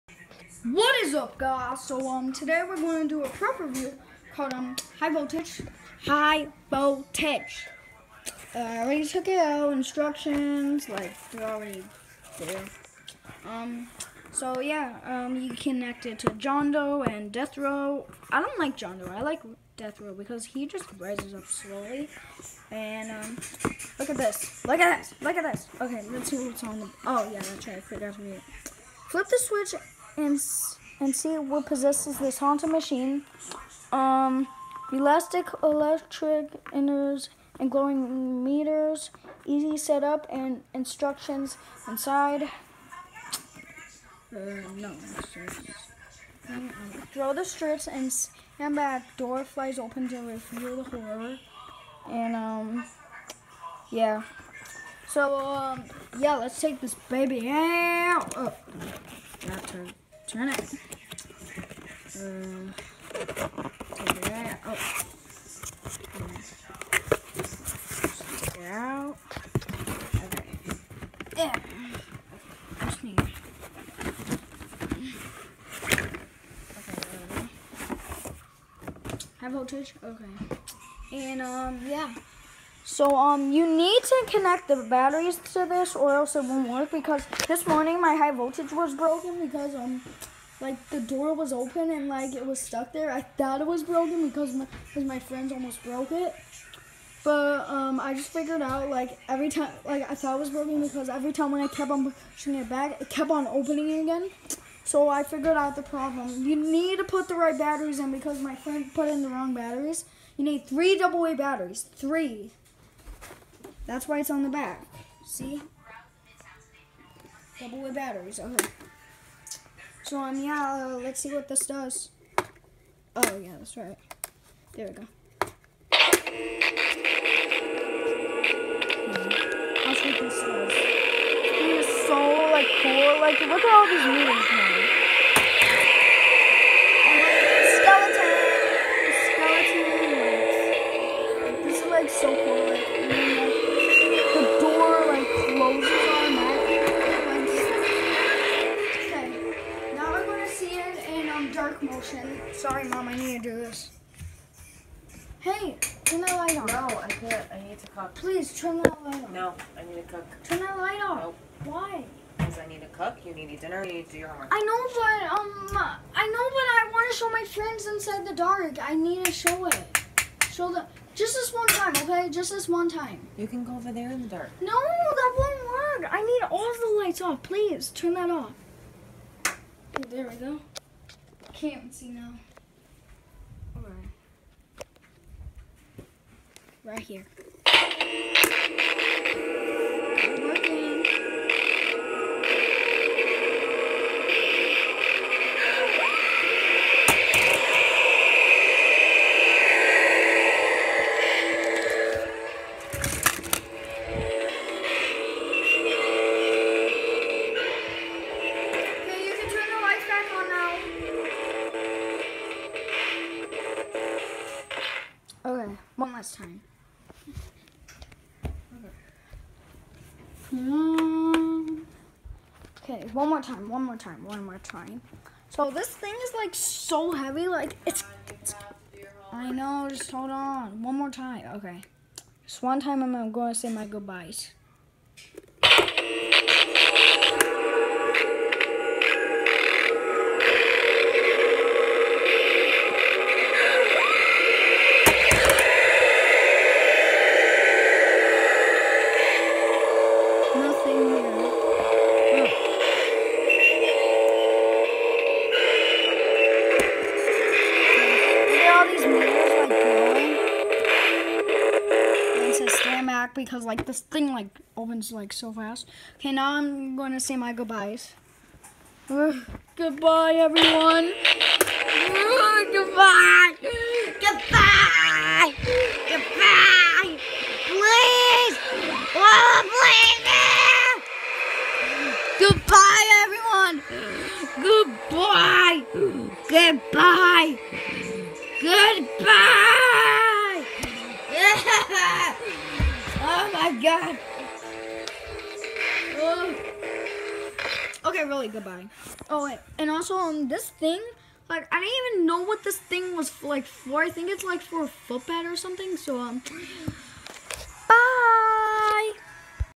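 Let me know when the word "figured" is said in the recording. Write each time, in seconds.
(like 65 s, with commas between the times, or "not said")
98 s, 105 s.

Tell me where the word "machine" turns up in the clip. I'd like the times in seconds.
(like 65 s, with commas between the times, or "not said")
32 s.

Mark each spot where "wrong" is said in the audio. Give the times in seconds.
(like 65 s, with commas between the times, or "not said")
109 s.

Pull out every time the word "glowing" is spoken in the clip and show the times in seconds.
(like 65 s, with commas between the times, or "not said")
37 s.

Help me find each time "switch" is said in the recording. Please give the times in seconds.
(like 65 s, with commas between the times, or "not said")
29 s.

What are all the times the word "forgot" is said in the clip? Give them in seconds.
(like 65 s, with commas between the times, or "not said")
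27 s.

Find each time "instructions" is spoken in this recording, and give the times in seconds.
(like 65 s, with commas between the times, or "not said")
9 s, 40 s.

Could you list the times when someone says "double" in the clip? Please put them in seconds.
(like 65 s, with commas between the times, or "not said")
110 s, 117 s.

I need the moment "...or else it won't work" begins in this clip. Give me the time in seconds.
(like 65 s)
85 s.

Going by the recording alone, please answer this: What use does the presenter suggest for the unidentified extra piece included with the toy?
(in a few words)
A footbed.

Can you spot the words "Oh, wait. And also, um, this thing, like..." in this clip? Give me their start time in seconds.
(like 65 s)
299 s.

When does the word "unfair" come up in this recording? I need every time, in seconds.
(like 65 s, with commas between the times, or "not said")
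not said.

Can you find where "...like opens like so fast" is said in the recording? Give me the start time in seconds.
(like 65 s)
264 s.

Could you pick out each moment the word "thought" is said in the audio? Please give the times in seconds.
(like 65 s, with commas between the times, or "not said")
93 s, 100 s.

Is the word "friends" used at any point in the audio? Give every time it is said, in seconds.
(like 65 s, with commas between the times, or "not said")
95 s, 108 s, 167 s.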